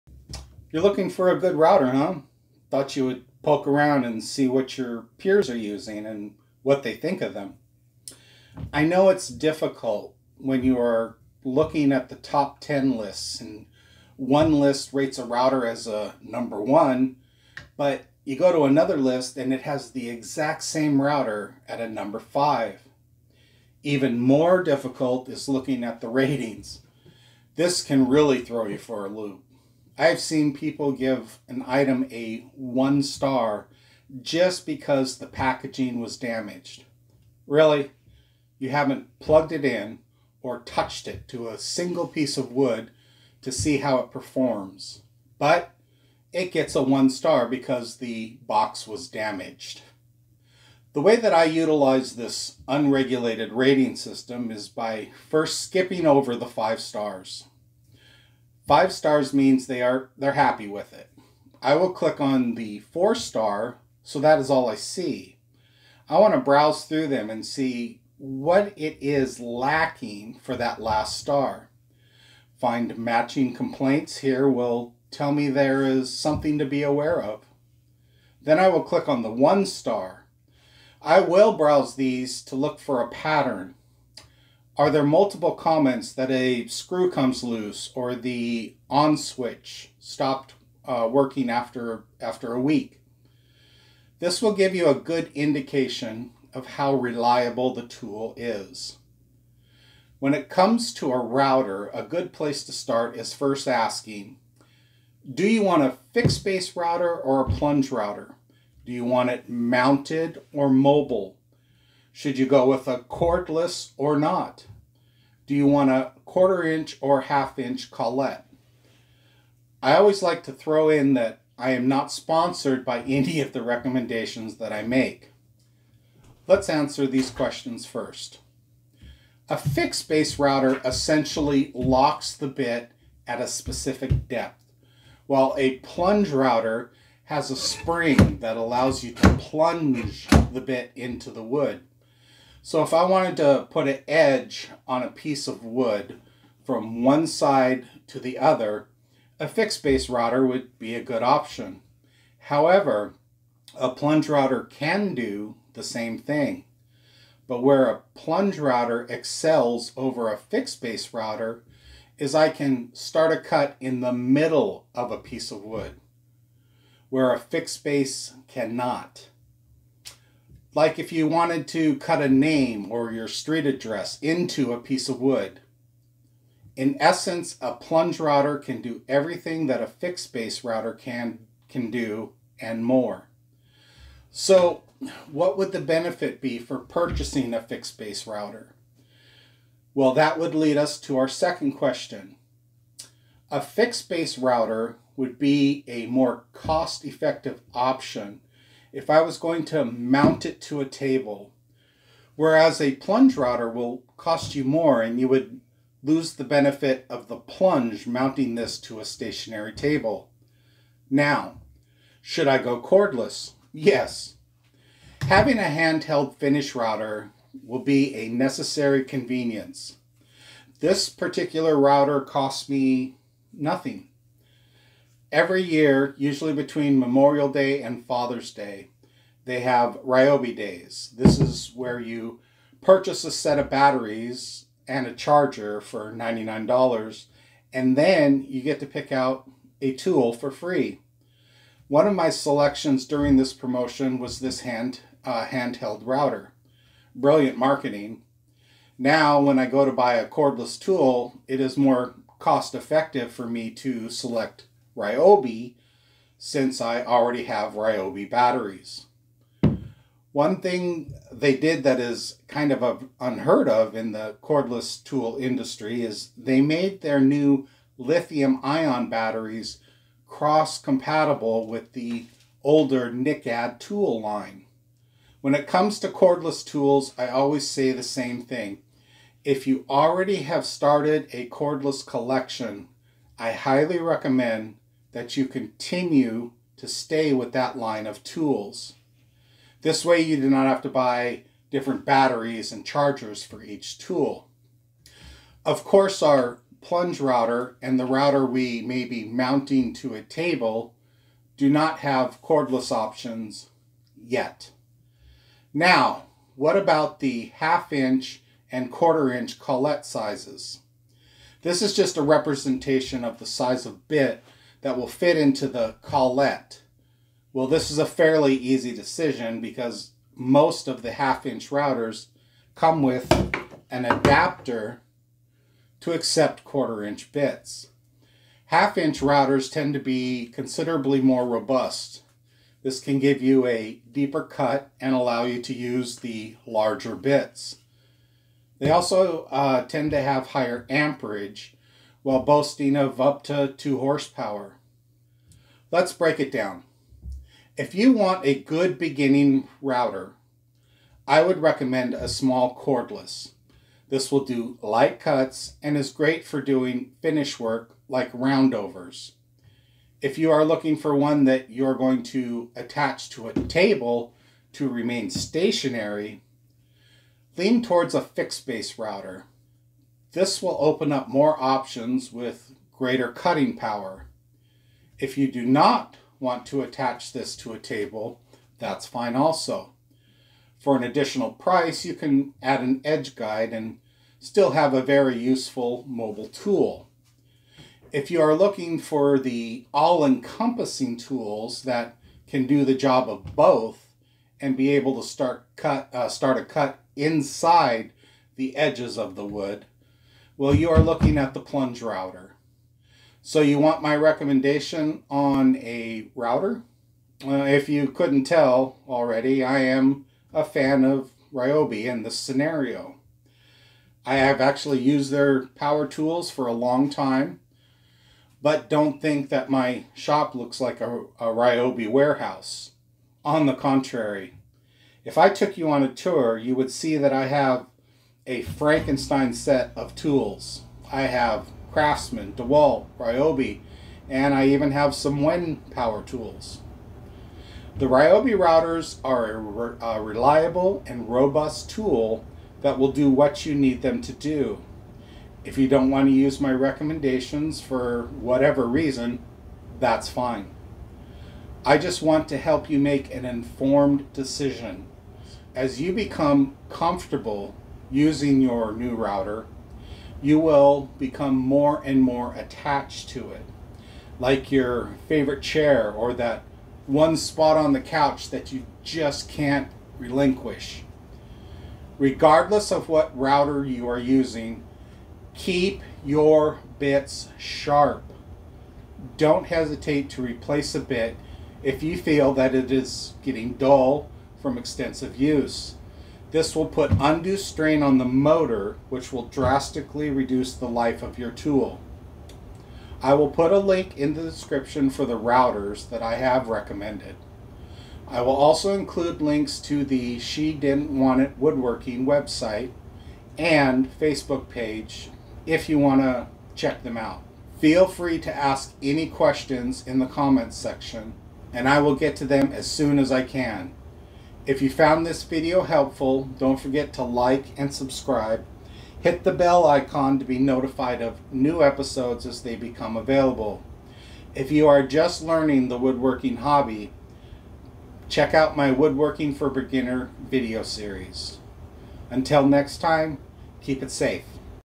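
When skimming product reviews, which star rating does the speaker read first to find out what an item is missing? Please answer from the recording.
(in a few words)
4 star.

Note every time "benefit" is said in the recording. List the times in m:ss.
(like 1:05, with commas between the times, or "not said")
3:05, 3:26.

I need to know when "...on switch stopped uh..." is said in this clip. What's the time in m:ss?
1:28.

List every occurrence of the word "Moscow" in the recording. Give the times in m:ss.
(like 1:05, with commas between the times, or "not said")
not said.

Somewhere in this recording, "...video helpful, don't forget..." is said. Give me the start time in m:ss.
8:35.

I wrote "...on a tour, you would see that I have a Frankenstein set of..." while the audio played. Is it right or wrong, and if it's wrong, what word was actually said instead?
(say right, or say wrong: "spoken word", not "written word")
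right.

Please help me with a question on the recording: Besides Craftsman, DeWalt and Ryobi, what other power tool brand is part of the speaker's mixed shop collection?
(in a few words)
Wen.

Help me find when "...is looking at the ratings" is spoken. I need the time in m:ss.
0:25.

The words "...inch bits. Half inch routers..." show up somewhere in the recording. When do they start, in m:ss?
5:27.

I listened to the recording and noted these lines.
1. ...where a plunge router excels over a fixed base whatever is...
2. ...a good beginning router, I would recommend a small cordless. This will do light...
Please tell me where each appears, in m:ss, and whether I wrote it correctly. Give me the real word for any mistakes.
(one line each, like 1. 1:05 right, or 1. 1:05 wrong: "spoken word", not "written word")
1. 2:37 wrong: "router", not "whatever"
2. 5:48 right.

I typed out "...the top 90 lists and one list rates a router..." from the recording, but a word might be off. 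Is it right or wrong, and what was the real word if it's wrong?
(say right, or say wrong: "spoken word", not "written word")
wrong: "10", not "90".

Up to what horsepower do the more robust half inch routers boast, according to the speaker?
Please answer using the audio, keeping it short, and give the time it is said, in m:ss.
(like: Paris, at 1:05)
2 horsepower, at 5:43.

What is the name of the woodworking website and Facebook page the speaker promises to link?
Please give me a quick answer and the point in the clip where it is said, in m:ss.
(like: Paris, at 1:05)
She Didn't Want It Woodworking, at 8:20.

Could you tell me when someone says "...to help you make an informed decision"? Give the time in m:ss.
7:32.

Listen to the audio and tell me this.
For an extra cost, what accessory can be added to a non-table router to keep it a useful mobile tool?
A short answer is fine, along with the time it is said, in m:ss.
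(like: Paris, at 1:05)
edge guide, at 6:23.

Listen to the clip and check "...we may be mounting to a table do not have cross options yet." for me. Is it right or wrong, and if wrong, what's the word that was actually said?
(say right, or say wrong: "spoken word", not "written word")
wrong: "cordless", not "cross".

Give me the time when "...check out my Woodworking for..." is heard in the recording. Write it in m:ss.
8:48.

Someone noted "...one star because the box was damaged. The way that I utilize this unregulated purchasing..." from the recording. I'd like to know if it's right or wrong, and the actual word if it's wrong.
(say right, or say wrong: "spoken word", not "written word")
wrong: "rating", not "purchasing".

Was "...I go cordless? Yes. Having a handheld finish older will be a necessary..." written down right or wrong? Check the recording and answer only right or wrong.
wrong.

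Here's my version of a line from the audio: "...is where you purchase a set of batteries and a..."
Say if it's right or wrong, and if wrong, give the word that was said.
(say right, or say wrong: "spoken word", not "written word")
right.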